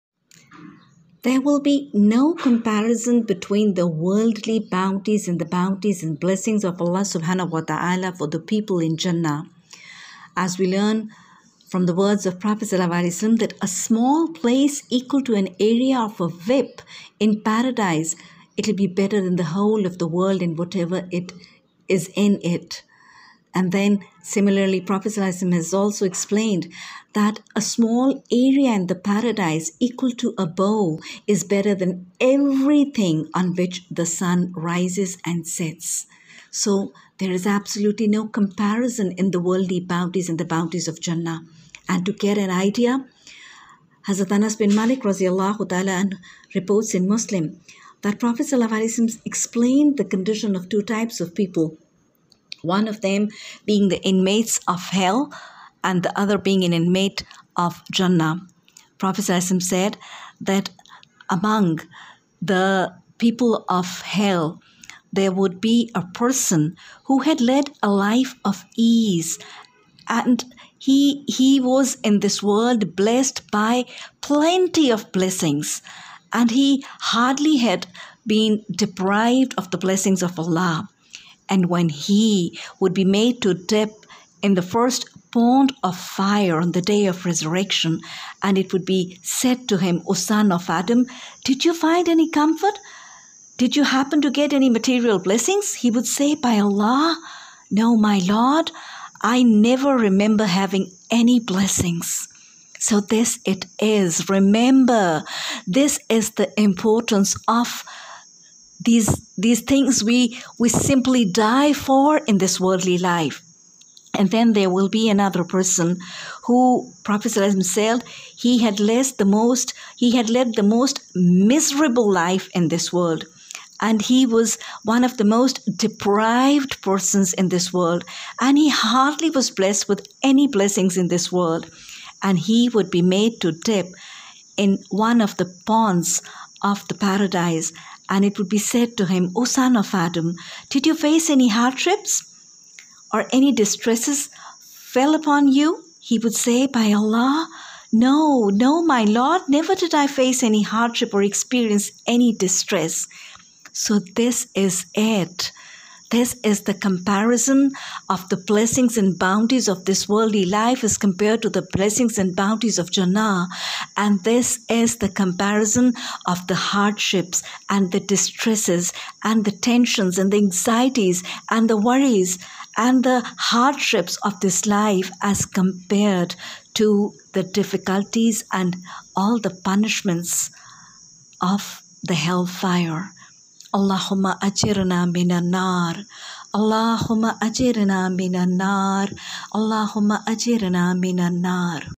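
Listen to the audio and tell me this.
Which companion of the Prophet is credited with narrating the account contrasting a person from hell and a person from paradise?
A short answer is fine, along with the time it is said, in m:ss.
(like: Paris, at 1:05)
Anas bin Malik, at 0:44.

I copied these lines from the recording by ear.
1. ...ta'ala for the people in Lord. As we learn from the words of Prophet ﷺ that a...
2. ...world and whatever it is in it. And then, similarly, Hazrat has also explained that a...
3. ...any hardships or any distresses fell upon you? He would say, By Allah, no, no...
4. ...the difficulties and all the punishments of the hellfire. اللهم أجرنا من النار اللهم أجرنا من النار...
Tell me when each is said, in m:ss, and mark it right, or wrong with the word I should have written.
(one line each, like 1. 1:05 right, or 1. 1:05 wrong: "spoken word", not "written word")
1. 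0:07 wrong: "Jannah", not "Lord"
2. 0:20 wrong: "Prophet", not "Hazrat"
3. 2:21 right
4. 2:57 right.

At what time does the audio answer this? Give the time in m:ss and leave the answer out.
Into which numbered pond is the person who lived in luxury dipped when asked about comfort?
1:24.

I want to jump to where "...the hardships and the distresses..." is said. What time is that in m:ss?
2:46.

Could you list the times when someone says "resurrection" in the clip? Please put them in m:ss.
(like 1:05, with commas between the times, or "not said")
1:27.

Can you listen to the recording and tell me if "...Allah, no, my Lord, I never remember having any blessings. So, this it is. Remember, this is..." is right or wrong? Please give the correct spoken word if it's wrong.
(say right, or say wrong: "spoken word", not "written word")
right.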